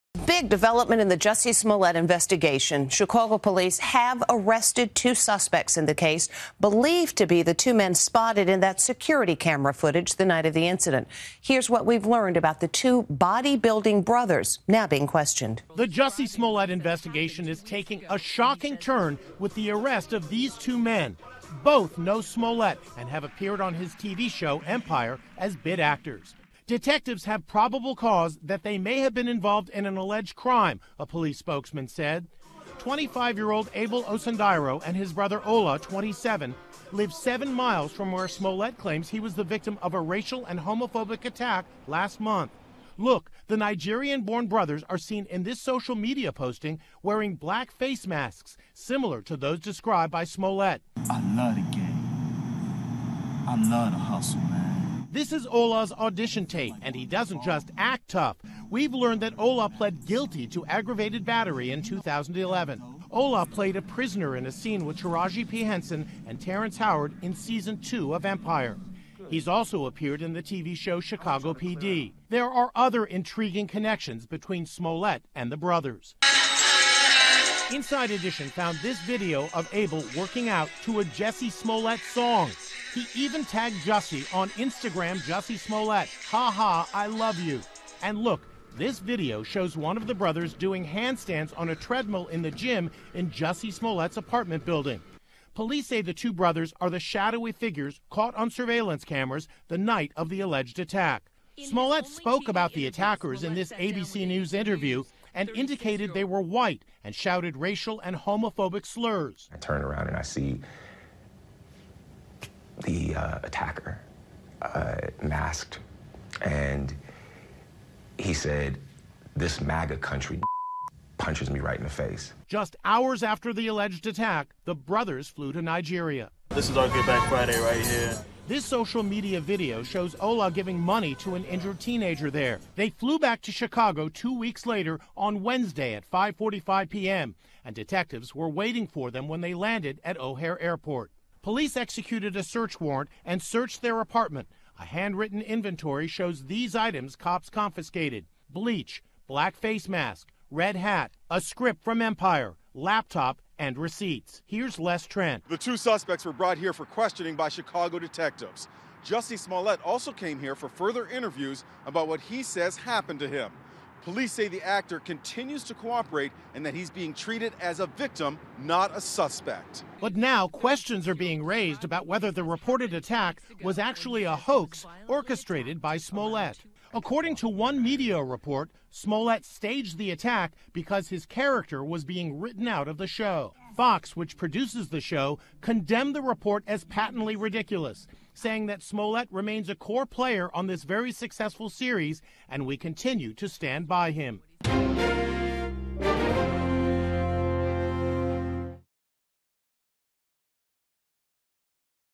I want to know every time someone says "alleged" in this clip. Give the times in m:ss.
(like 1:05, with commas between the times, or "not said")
0:29, 1:40, 2:03.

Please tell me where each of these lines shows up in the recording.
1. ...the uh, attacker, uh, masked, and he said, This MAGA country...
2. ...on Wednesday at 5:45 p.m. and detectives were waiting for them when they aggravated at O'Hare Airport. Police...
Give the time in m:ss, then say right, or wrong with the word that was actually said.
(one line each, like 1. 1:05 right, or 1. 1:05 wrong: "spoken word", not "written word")
1. 1:52 right
2. 2:15 wrong: "landed", not "aggravated".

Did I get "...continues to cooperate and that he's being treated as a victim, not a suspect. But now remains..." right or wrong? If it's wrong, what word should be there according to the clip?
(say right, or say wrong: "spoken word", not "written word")
wrong: "questions", not "remains".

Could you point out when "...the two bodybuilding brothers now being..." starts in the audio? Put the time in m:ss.
0:12.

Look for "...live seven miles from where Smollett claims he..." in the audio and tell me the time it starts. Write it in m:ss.
0:36.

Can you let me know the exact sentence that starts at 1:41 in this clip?
In Smollett spoke about the attackers in this ABC News interview and indicated they were white and shouted racial and homophobic slurs.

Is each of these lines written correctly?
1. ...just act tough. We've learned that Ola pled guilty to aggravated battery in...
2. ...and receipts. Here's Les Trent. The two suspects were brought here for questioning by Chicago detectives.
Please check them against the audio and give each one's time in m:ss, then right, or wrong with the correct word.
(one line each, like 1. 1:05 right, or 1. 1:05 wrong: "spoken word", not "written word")
1. 0:57 right
2. 2:33 right.